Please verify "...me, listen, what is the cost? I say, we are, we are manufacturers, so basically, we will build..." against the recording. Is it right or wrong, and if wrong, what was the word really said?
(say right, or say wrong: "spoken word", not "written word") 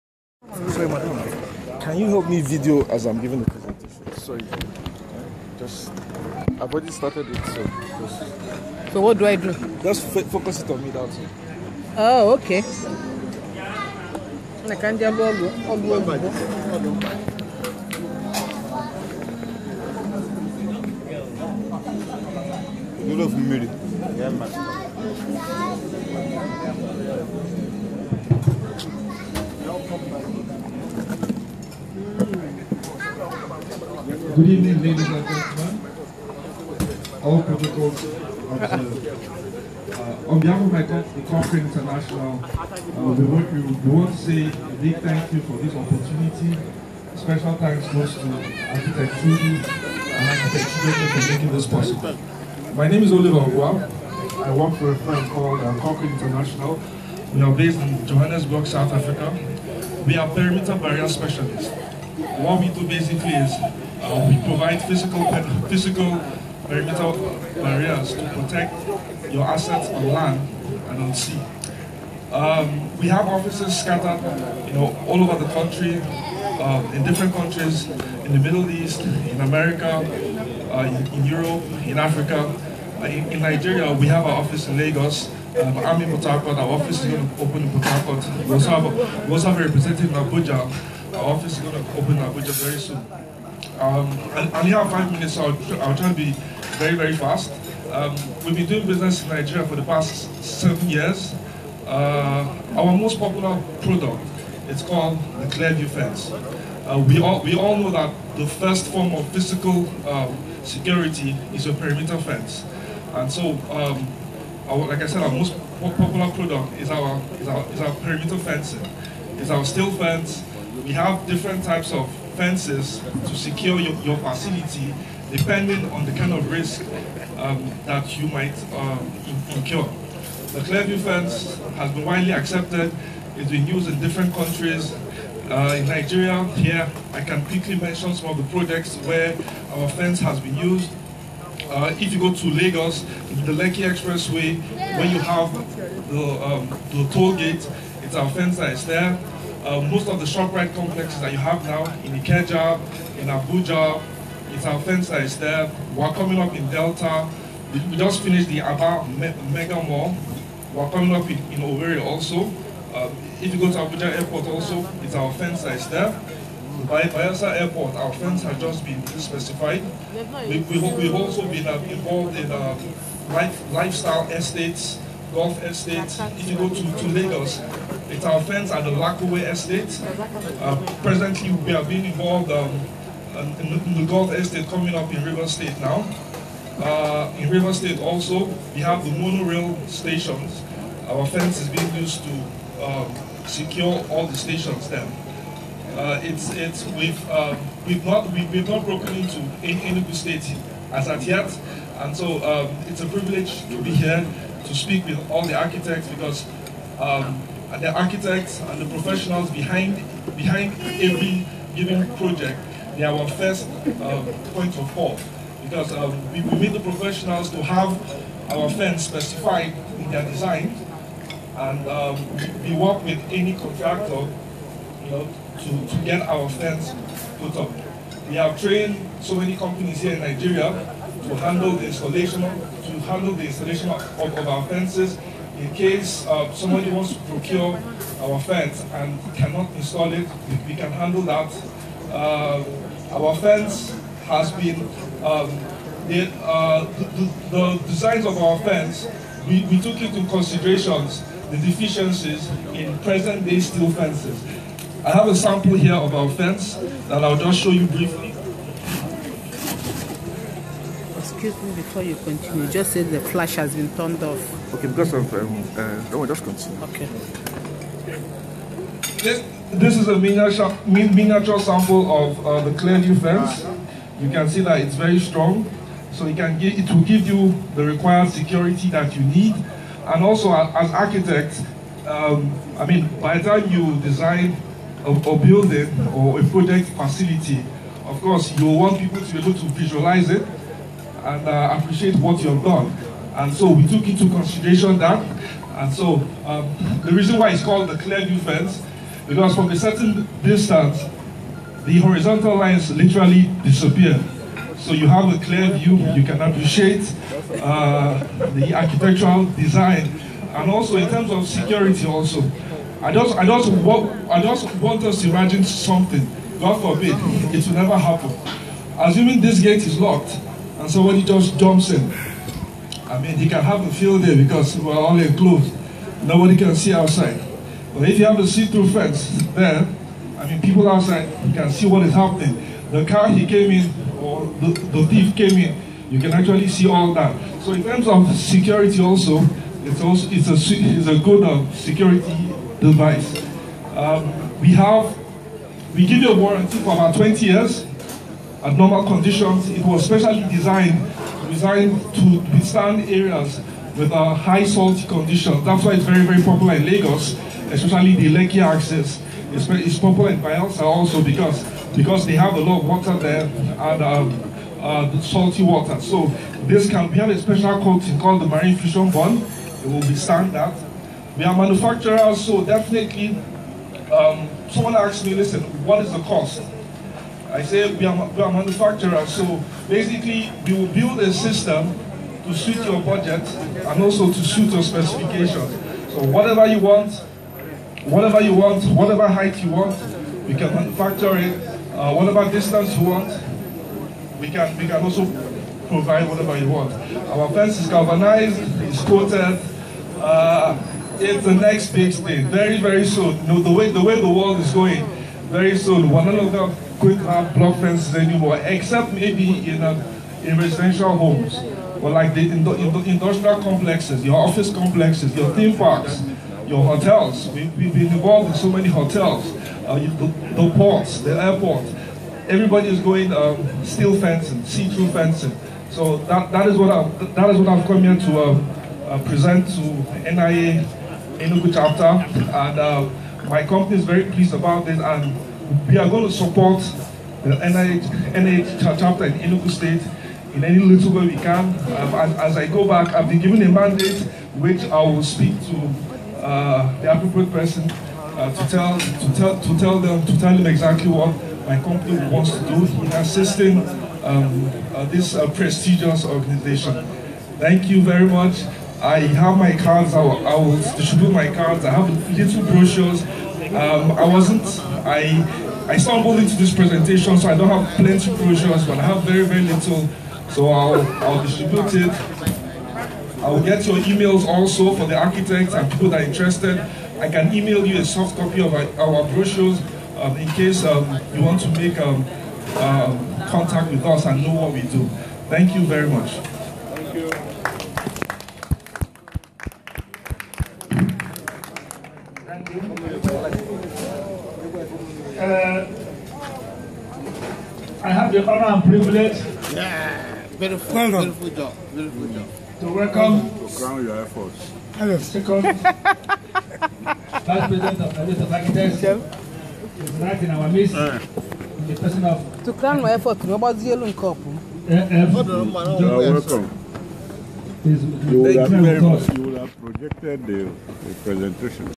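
right.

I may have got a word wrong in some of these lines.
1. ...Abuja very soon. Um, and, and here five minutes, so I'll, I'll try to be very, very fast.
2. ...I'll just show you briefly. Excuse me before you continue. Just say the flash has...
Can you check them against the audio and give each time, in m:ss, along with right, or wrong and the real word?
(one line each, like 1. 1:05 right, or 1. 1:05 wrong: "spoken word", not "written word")
1. 1:32 right
2. 4:17 right.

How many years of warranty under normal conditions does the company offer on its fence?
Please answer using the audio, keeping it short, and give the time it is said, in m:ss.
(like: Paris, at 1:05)
20 years, at 5:47.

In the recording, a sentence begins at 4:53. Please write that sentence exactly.
And so we took into consideration that.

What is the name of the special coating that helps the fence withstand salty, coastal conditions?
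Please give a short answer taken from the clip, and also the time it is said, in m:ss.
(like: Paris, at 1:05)
marine fusion bond, at 6:08.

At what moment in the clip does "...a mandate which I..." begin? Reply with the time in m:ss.
7:23.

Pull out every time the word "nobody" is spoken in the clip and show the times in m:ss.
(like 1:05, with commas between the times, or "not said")
5:26, 8:33.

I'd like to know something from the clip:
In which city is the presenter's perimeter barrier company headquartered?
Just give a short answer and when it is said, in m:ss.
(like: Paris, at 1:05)
Johannesburg, at 0:58.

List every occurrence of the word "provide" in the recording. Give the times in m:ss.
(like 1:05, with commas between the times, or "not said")
1:04, 6:35.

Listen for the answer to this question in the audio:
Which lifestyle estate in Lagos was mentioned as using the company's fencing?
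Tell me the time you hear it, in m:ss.
2:58.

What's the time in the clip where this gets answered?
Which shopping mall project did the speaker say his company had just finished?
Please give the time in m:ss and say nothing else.
2:38.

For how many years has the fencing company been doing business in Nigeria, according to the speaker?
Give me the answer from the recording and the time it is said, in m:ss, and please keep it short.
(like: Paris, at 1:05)
7, at 1:40.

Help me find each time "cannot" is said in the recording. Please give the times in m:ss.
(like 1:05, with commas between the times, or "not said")
3:59.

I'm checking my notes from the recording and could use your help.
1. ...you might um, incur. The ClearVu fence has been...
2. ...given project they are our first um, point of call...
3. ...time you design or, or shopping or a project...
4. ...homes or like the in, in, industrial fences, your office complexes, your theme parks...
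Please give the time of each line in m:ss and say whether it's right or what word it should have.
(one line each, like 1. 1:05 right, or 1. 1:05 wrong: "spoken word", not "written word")
1. 2:08 right
2. 3:31 right
3. 4:43 wrong: "building", not "shopping"
4. 6:51 wrong: "complexes", not "fences".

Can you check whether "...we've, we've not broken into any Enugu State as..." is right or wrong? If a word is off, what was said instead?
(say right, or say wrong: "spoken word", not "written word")
right.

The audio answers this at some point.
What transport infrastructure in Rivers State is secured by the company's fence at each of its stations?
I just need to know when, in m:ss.
3:09.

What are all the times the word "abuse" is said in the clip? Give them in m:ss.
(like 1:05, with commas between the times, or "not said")
not said.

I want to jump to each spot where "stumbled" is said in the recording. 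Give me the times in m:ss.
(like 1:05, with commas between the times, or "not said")
7:45.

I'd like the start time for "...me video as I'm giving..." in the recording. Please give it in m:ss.
0:02.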